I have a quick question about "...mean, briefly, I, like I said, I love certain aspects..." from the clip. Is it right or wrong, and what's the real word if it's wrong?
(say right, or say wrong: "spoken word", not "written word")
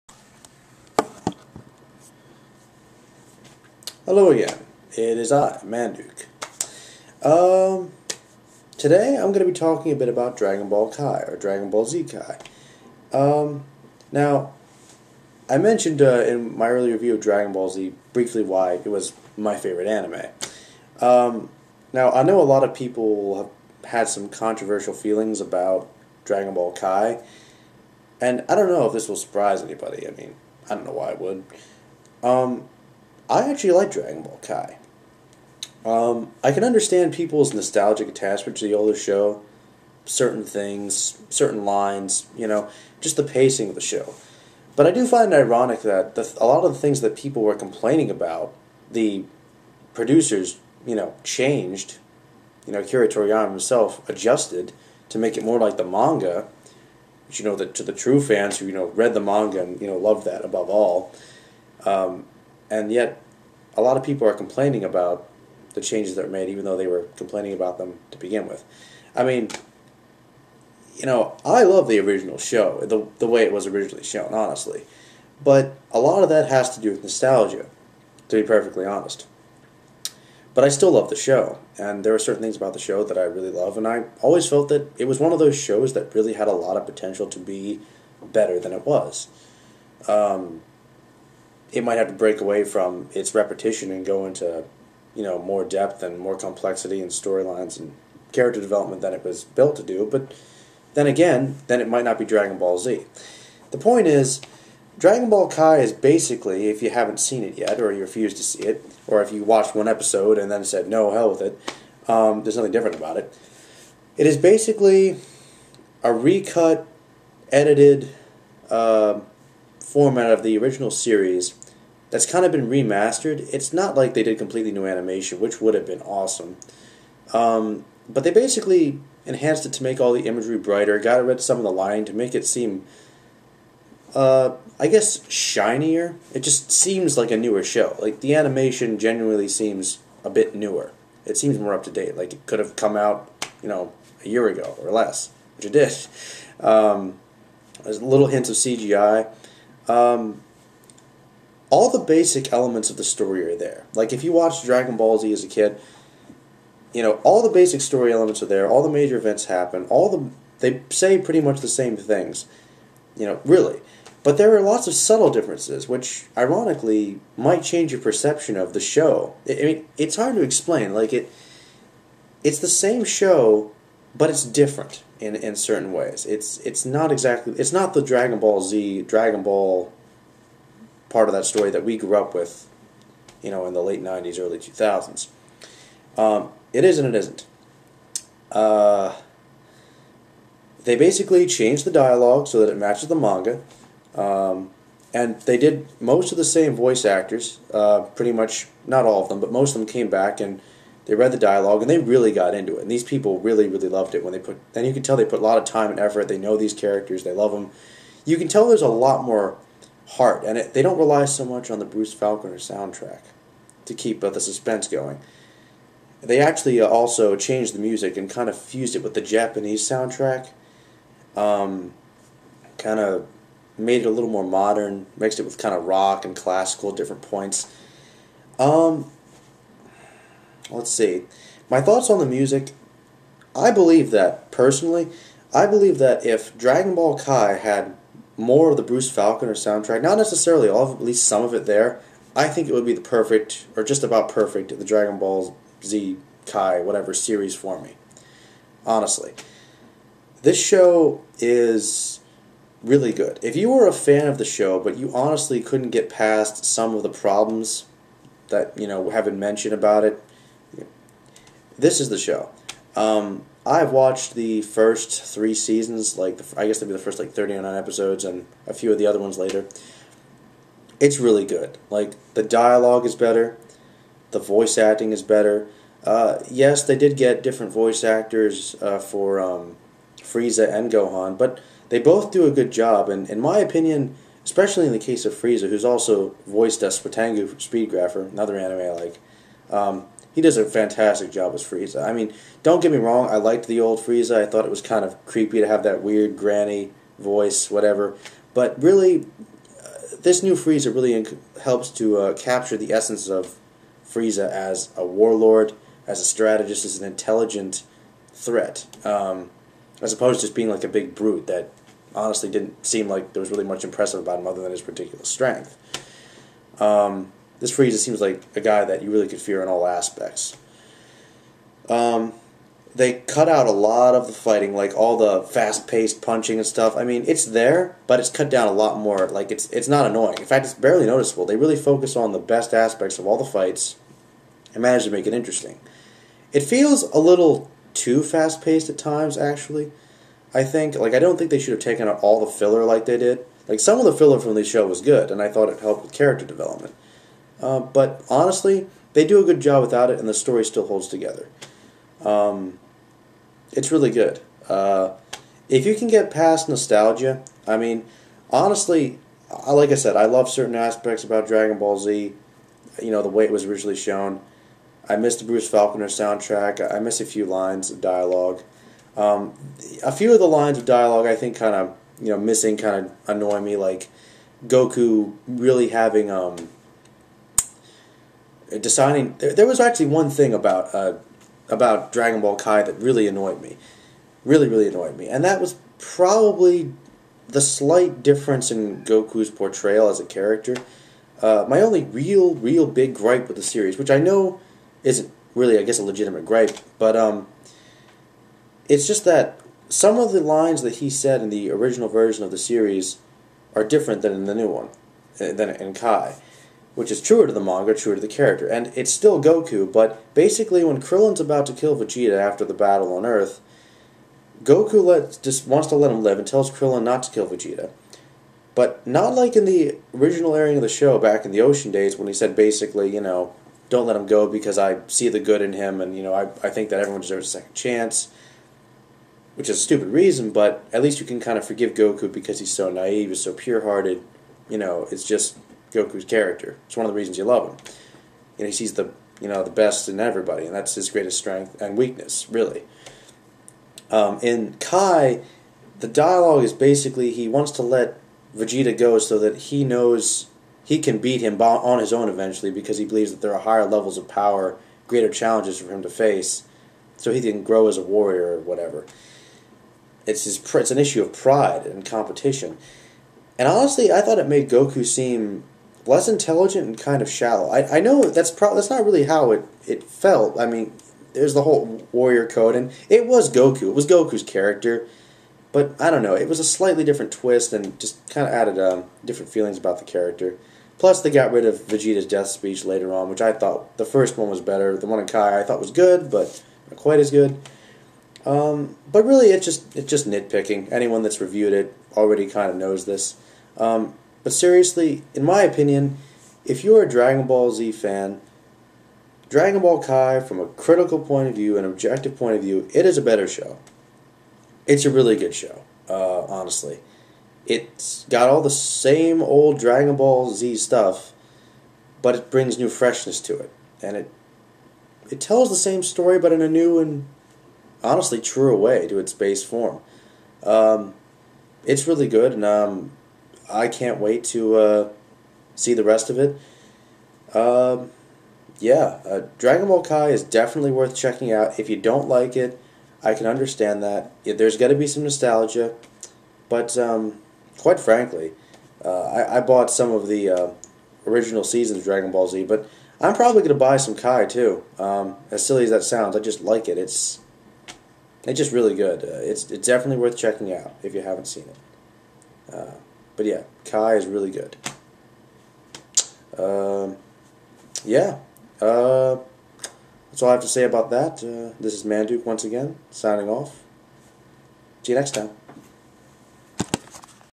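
wrong: "honestly", not "briefly".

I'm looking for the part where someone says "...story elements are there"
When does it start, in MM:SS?
02:37.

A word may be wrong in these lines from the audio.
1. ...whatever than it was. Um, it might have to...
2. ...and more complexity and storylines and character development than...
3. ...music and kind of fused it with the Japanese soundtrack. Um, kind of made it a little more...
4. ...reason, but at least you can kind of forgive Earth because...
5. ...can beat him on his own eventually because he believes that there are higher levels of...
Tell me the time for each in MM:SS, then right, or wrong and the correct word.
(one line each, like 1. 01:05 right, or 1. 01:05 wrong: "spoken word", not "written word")
1. 01:28 wrong: "better", not "whatever"
2. 01:36 right
3. 03:37 right
4. 07:10 wrong: "Goku", not "Earth"
5. 07:30 right.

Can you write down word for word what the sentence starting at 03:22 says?
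And these people really, really loved it when they put, and you can tell they put a lot of time and effort.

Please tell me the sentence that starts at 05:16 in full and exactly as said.
Um, this Frieza seems like a guy that you really could fear in all aspects.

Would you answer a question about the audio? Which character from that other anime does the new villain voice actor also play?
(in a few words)
Suitengu.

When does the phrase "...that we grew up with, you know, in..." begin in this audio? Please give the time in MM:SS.
03:01.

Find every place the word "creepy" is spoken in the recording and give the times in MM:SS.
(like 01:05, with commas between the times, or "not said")
04:55.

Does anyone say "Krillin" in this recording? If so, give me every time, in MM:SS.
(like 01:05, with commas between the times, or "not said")
06:51, 06:56.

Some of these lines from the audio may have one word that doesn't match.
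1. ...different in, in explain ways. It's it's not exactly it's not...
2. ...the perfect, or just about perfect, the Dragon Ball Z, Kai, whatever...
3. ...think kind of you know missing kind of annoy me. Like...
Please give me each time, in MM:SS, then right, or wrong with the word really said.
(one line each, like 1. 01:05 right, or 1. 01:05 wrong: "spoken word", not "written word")
1. 02:54 wrong: "certain", not "explain"
2. 04:02 right
3. 06:11 right.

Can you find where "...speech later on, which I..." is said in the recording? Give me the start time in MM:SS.
08:02.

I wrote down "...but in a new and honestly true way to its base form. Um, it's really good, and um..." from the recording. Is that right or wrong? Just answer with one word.
right.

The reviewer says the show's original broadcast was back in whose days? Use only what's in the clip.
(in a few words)
Ocean.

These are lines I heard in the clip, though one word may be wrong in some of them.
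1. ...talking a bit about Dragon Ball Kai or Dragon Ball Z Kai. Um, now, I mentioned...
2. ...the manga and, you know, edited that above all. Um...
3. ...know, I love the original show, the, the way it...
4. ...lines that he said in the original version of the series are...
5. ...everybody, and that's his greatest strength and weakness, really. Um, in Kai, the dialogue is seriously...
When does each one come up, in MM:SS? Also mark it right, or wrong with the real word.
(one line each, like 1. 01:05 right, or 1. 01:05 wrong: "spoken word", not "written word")
1. 00:09 right
2. 00:59 wrong: "loved", not "edited"
3. 01:11 right
4. 06:40 right
5. 07:20 wrong: "basically", not "seriously".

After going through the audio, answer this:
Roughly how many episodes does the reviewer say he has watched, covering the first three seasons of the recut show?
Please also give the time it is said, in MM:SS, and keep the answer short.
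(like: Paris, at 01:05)
39, at 04:27.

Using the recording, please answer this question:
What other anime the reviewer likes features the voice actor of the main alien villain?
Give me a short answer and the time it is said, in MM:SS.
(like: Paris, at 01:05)
Speedgrapher, at 04:47.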